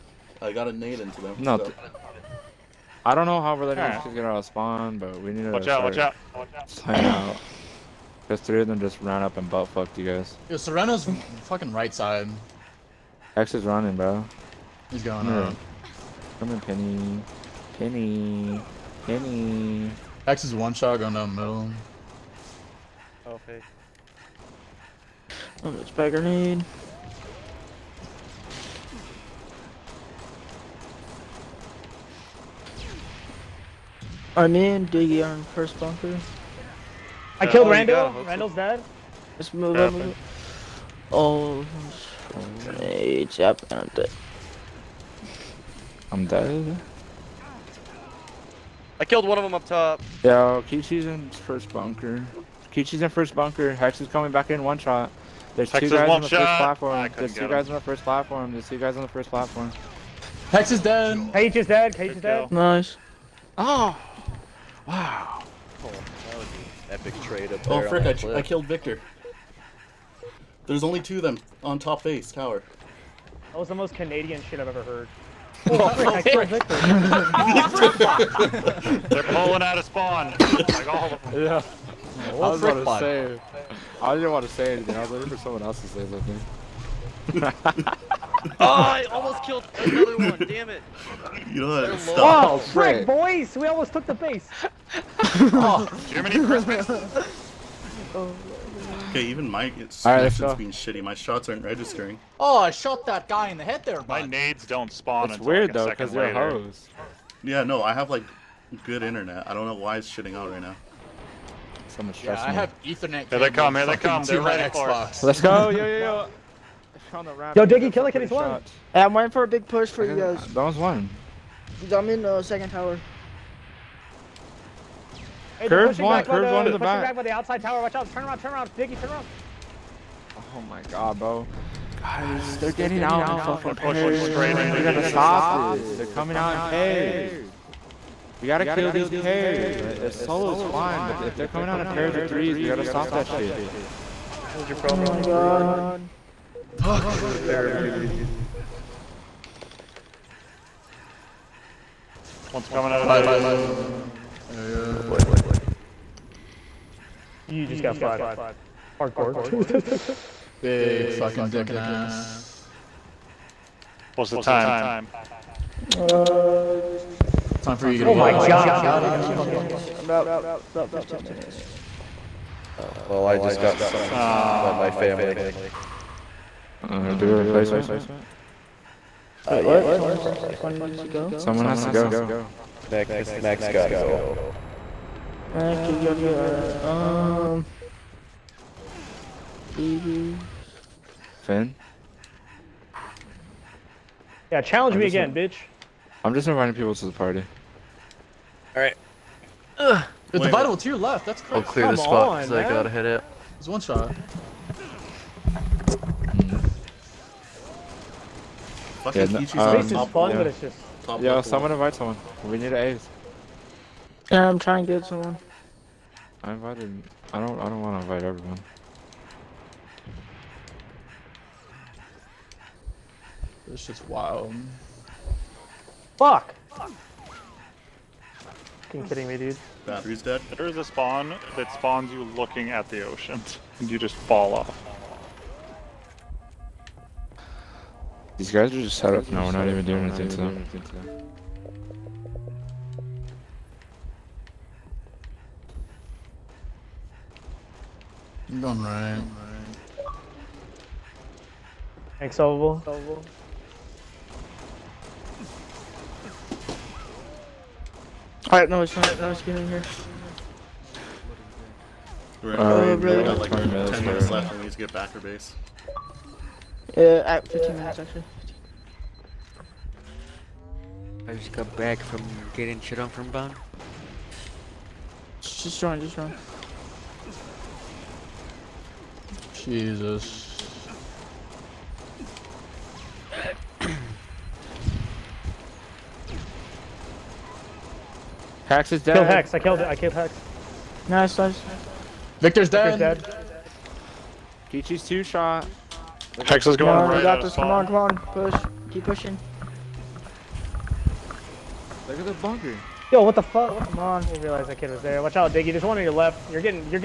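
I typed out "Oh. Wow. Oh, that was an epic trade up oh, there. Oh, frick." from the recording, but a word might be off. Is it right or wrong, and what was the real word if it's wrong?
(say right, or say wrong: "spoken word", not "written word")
right.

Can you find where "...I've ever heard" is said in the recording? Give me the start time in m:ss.
1:14.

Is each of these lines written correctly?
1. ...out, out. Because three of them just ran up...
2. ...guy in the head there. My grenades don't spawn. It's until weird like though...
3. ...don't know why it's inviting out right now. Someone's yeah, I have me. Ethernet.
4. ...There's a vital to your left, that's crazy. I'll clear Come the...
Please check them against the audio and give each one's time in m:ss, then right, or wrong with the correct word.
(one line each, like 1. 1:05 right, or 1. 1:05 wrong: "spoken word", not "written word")
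1. 0:06 right
2. 1:43 wrong: "nades", not "grenades"
3. 1:49 wrong: "shitting", not "inviting"
4. 3:20 right.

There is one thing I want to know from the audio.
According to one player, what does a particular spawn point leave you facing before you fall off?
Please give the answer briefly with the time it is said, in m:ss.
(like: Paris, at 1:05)
the ocean, at 3:52.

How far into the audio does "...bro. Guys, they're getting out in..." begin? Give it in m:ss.
2:11.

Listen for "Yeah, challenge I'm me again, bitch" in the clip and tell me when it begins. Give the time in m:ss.
3:14.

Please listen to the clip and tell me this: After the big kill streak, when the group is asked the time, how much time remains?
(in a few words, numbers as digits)
15 minutes.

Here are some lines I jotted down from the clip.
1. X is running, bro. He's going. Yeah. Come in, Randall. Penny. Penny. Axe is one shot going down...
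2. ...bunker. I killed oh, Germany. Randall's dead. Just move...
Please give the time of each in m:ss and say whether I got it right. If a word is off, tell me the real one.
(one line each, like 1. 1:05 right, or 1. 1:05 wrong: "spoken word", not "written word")
1. 0:13 wrong: "Penny", not "Randall"
2. 0:35 wrong: "Randall", not "Germany".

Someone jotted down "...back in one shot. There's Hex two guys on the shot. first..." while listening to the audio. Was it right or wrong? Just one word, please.
right.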